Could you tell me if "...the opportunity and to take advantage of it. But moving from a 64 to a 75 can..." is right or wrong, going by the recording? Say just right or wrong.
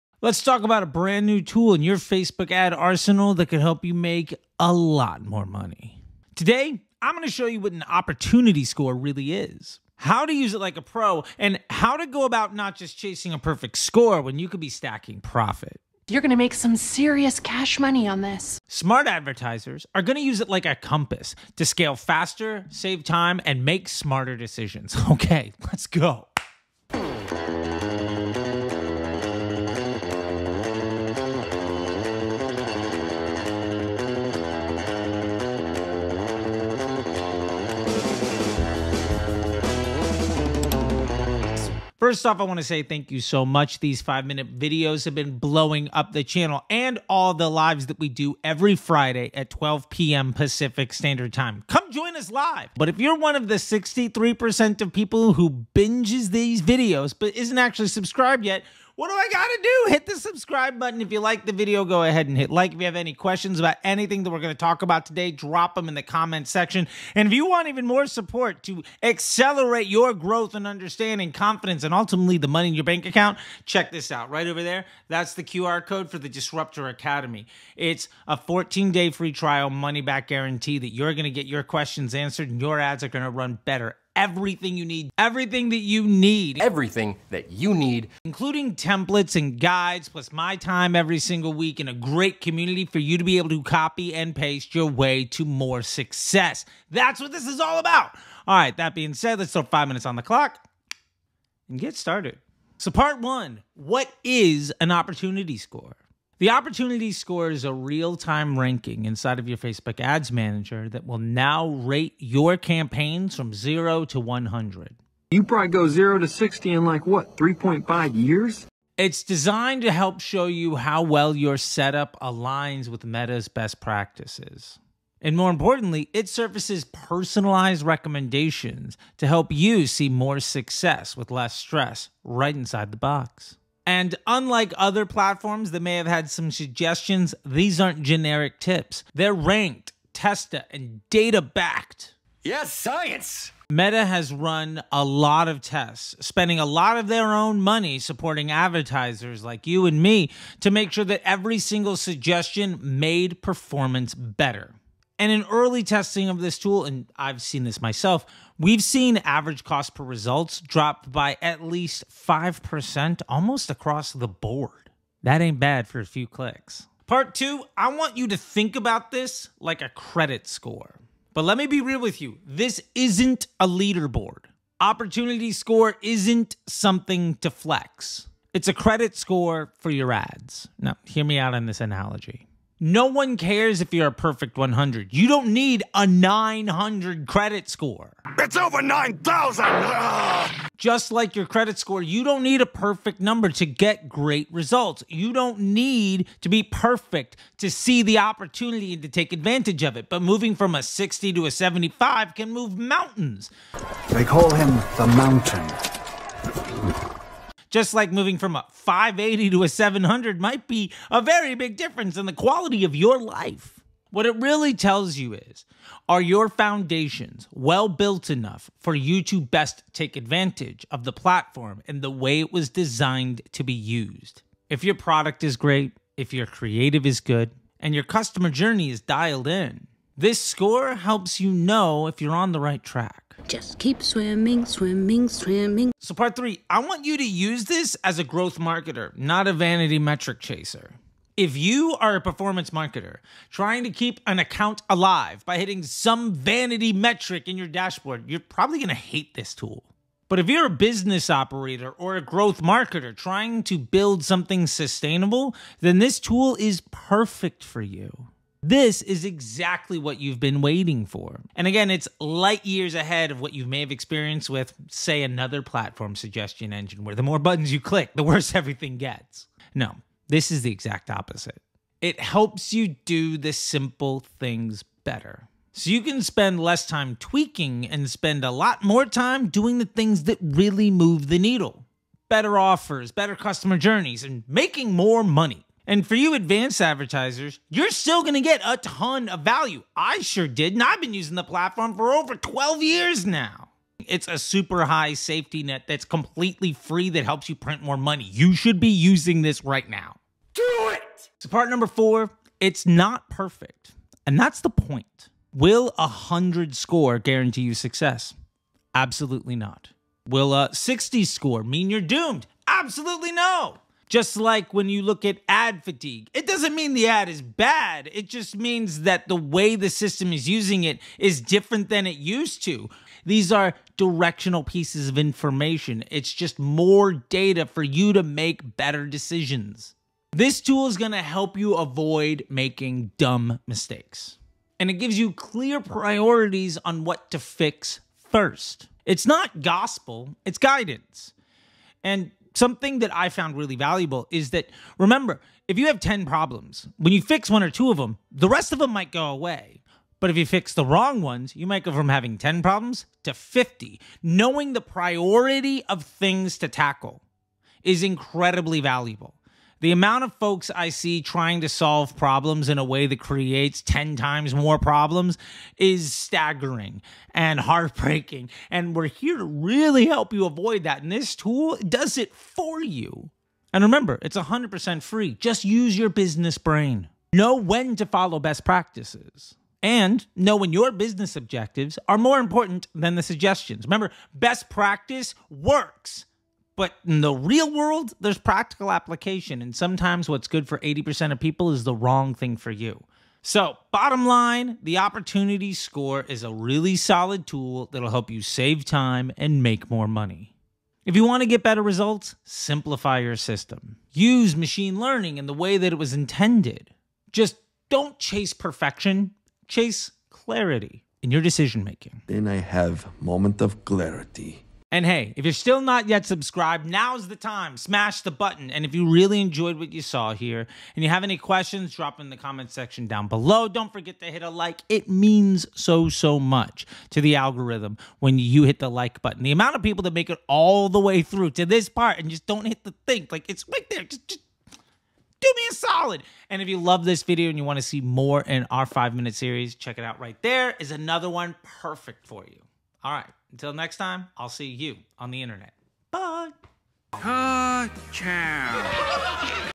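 wrong.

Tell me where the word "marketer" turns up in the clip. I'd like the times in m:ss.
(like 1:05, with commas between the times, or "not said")
3:58, 4:02, 4:12.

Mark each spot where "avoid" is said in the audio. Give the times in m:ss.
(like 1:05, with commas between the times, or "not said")
5:31, 6:10.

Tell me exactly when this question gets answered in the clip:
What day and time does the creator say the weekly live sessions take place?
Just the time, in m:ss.
0:48.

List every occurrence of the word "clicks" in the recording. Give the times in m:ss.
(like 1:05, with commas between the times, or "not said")
2:46, 4:27.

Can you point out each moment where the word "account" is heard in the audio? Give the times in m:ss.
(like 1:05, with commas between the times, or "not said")
1:13, 4:04.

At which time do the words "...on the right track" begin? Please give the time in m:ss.
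3:52.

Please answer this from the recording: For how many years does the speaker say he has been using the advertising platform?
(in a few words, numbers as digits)
Over 12 years.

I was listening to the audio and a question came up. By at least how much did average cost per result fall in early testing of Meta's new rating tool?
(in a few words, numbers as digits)
5%.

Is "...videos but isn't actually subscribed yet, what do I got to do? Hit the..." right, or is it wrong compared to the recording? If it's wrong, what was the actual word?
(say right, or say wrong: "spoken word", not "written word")
right.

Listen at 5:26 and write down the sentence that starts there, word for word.
It's just more data for you to make better decisions.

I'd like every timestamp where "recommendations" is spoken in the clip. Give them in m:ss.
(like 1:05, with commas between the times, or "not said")
2:07.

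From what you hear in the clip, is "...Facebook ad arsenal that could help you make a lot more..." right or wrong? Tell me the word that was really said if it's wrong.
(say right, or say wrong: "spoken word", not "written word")
right.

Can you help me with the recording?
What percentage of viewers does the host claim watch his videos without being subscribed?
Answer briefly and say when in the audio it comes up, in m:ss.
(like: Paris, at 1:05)
63%, at 0:53.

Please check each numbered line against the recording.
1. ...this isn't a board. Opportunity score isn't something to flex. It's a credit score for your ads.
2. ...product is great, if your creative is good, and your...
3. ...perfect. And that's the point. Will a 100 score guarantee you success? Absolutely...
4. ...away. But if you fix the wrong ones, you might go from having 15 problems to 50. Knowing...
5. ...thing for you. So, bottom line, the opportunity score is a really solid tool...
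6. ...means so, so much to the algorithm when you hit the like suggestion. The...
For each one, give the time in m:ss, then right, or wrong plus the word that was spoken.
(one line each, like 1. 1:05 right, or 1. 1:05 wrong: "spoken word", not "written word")
1. 2:52 wrong: "leaderboard", not "board"
2. 3:44 right
3. 5:03 right
4. 5:49 wrong: "10", not "15"
5. 6:32 right
6. 7:05 wrong: "button", not "suggestion".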